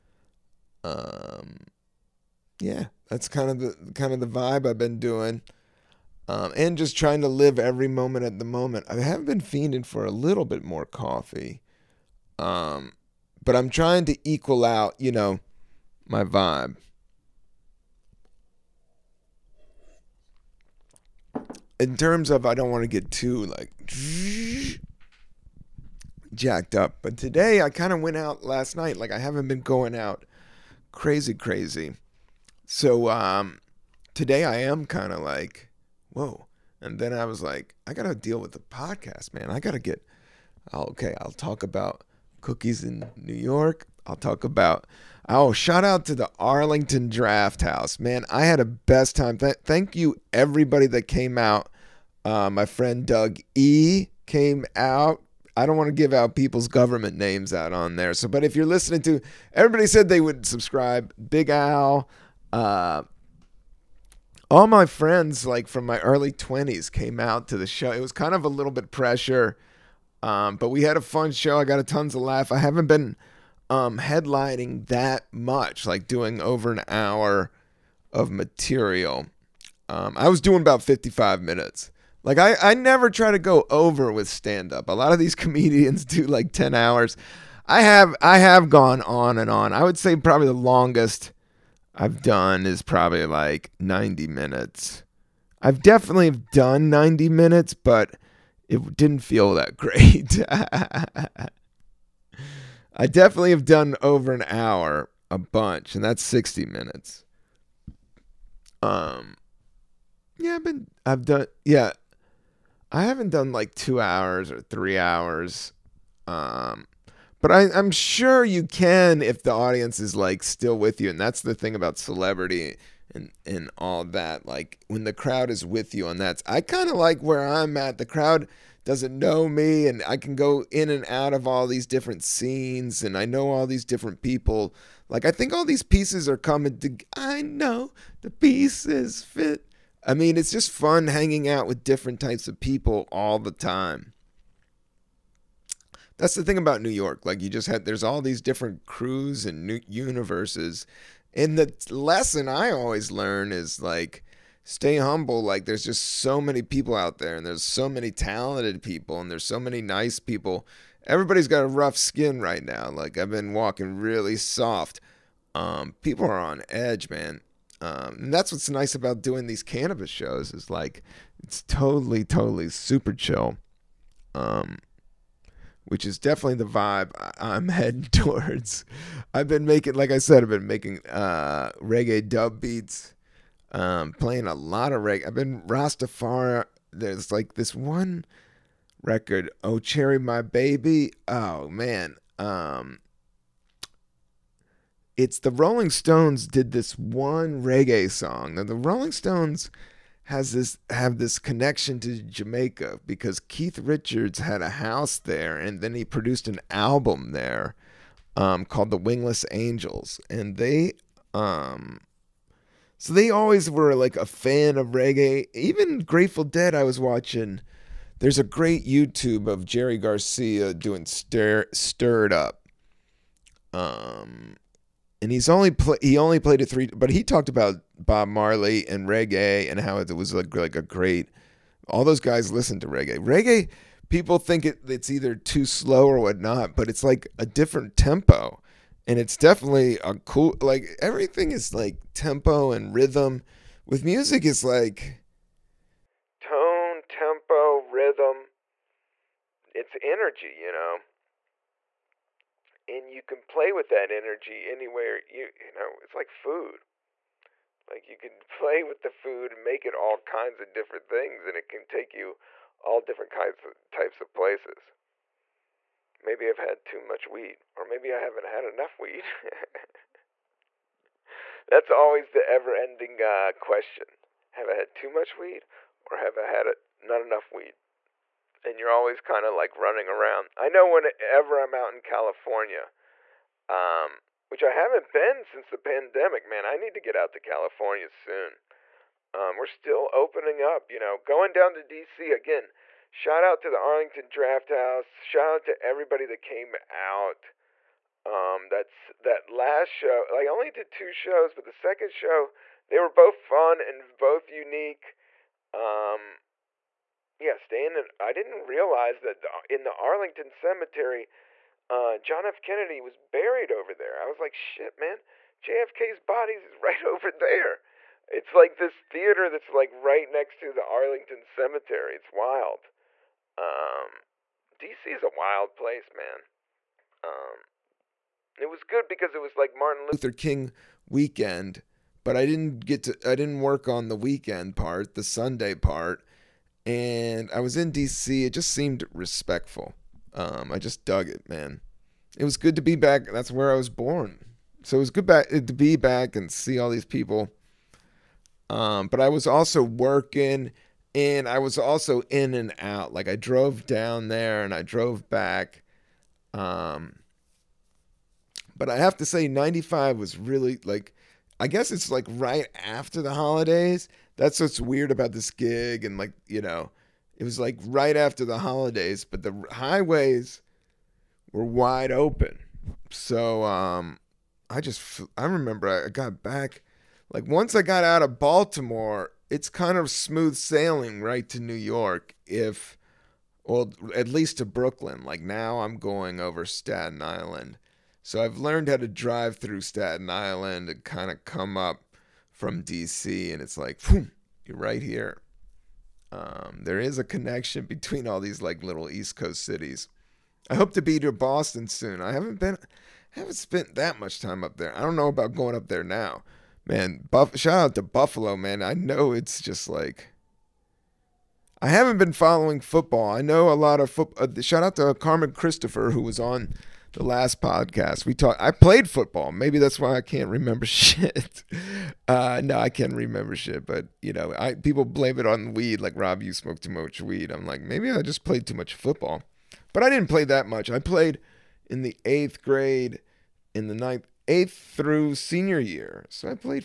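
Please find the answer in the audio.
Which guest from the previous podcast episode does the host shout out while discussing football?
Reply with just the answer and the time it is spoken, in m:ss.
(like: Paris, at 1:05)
Carmen Christopher, at 6:55.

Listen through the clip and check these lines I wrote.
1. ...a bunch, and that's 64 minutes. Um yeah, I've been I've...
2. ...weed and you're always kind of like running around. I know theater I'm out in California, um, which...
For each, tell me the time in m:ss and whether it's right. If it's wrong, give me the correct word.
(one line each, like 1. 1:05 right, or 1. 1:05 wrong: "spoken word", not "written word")
1. 1:45 wrong: "60", not "64"
2. 4:37 wrong: "whenever", not "theater".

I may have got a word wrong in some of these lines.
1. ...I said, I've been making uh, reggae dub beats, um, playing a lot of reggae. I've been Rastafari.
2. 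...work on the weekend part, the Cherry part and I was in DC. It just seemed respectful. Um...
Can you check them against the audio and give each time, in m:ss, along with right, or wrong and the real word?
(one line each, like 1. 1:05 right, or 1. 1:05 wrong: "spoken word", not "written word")
1. 3:00 right
2. 5:33 wrong: "Sunday", not "Cherry".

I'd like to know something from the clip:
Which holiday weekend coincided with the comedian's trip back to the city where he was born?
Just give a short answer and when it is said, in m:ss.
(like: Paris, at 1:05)
Martin Luther King weekend, at 5:29.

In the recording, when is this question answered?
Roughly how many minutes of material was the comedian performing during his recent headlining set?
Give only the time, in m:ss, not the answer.
1:20.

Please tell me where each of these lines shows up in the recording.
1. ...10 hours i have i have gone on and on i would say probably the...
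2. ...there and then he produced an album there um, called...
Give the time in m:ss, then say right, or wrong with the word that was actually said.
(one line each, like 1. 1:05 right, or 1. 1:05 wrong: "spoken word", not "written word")
1. 1:26 right
2. 3:25 right.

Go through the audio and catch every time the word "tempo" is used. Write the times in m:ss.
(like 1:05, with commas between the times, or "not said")
3:57, 4:02, 4:07.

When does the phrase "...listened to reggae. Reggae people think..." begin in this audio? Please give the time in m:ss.
3:52.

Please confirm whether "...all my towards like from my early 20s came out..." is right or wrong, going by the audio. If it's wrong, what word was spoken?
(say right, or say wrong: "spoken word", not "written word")
wrong: "friends", not "towards".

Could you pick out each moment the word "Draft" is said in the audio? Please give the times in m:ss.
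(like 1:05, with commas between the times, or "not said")
0:47, 4:54.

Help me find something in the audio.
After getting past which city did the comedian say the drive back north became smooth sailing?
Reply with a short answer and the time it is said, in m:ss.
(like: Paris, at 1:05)
Baltimore, at 6:18.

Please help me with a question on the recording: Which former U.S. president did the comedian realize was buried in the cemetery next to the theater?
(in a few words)
John F. Kennedy.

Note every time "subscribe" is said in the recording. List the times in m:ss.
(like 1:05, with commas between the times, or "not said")
1:00.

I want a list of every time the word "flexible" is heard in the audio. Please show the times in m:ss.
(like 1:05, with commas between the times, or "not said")
not said.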